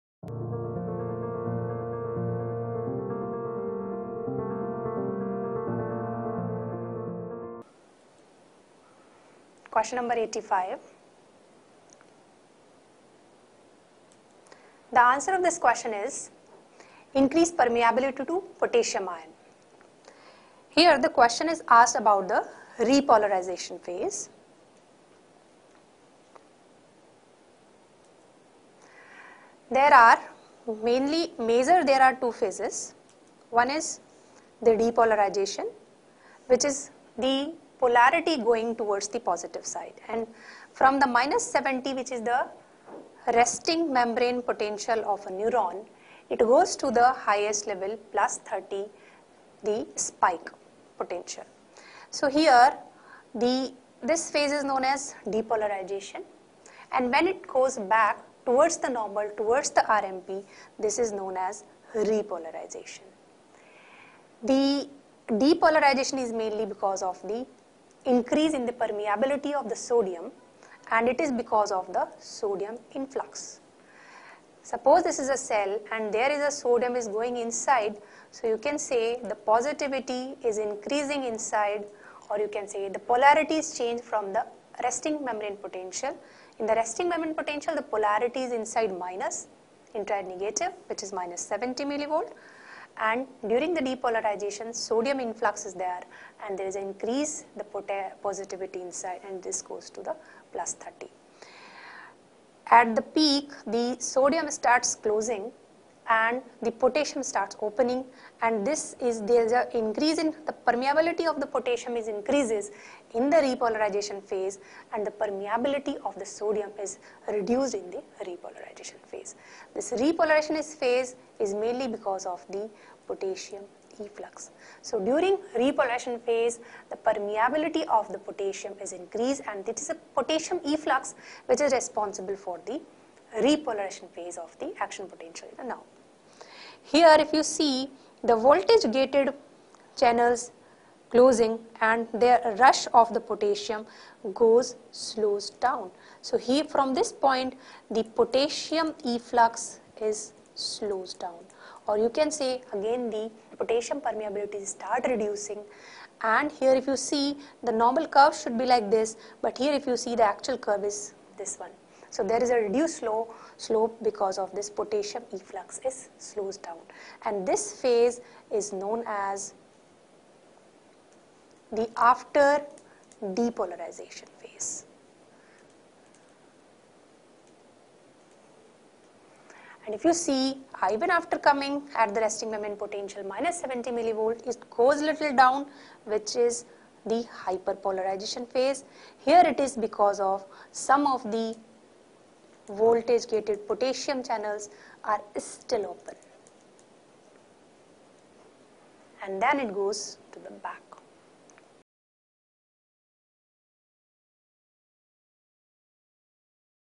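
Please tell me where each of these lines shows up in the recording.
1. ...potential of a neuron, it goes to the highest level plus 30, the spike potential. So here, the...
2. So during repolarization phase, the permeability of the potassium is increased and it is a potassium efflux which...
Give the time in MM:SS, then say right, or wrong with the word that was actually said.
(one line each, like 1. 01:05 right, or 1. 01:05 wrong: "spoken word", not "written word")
1. 00:44 right
2. 02:04 right.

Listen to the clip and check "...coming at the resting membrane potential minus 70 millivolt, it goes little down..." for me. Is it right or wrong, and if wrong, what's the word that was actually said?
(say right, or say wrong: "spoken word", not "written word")
right.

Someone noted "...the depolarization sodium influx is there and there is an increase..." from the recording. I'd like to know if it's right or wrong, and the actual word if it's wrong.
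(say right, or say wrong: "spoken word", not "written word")
right.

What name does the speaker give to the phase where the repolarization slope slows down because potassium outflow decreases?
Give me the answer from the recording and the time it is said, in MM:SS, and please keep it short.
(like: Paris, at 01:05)
after depolarization phase, at 02:51.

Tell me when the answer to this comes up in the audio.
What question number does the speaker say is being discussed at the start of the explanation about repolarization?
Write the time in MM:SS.
00:10.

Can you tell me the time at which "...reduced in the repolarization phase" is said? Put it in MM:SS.
01:57.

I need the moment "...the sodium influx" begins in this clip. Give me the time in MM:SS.
01:11.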